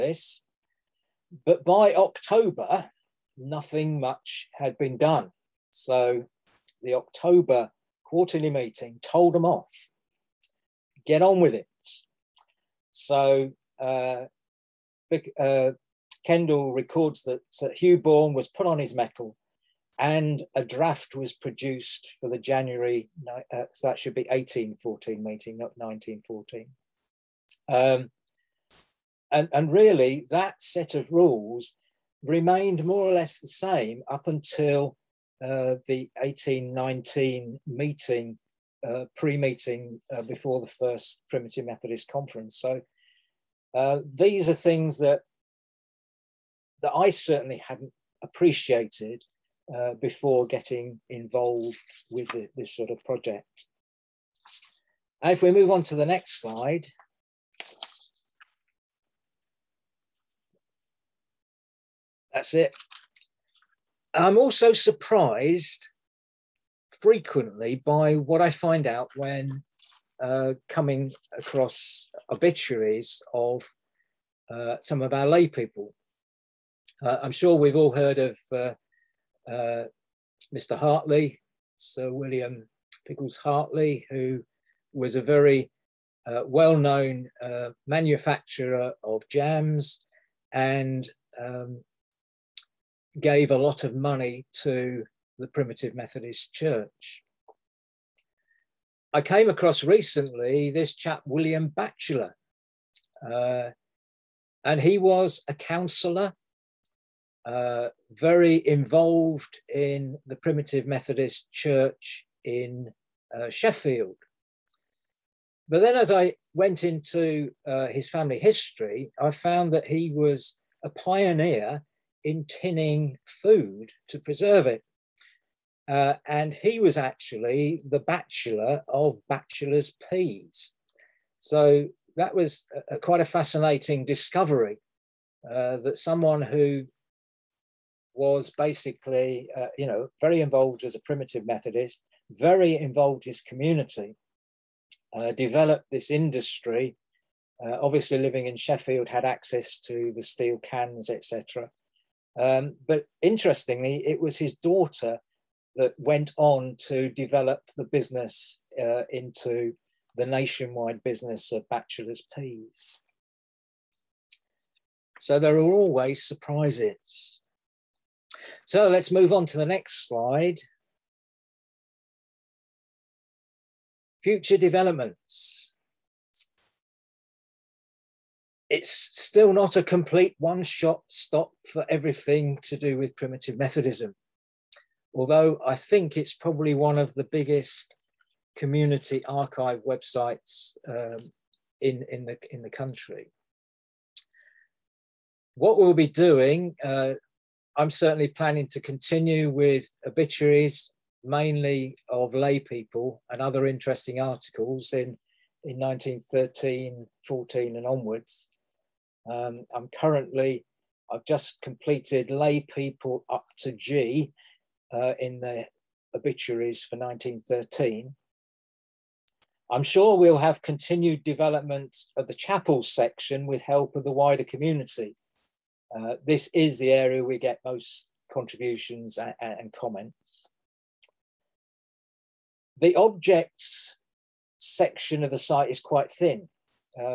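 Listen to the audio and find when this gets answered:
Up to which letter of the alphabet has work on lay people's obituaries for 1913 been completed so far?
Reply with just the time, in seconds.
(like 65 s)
213 s.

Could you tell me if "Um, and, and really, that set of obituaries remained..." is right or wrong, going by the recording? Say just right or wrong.
wrong.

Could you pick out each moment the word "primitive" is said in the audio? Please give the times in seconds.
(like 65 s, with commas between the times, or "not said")
41 s, 95 s, 110 s, 140 s, 183 s.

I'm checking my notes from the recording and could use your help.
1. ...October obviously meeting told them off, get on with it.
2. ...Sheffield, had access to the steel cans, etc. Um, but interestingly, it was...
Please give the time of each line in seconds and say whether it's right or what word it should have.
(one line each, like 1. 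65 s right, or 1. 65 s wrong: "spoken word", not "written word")
1. 6 s wrong: "quarterly", not "obviously"
2. 148 s right.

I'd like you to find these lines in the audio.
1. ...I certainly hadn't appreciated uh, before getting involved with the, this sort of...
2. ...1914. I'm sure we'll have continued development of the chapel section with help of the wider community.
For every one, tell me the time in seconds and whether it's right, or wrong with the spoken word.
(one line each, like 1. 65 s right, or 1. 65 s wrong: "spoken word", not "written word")
1. 46 s right
2. 216 s wrong: "1913", not "1914".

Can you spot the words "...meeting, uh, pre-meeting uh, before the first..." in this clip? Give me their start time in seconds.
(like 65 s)
37 s.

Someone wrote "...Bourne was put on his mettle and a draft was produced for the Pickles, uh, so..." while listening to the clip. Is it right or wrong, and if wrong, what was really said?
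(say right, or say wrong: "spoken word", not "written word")
wrong: "January", not "Pickles".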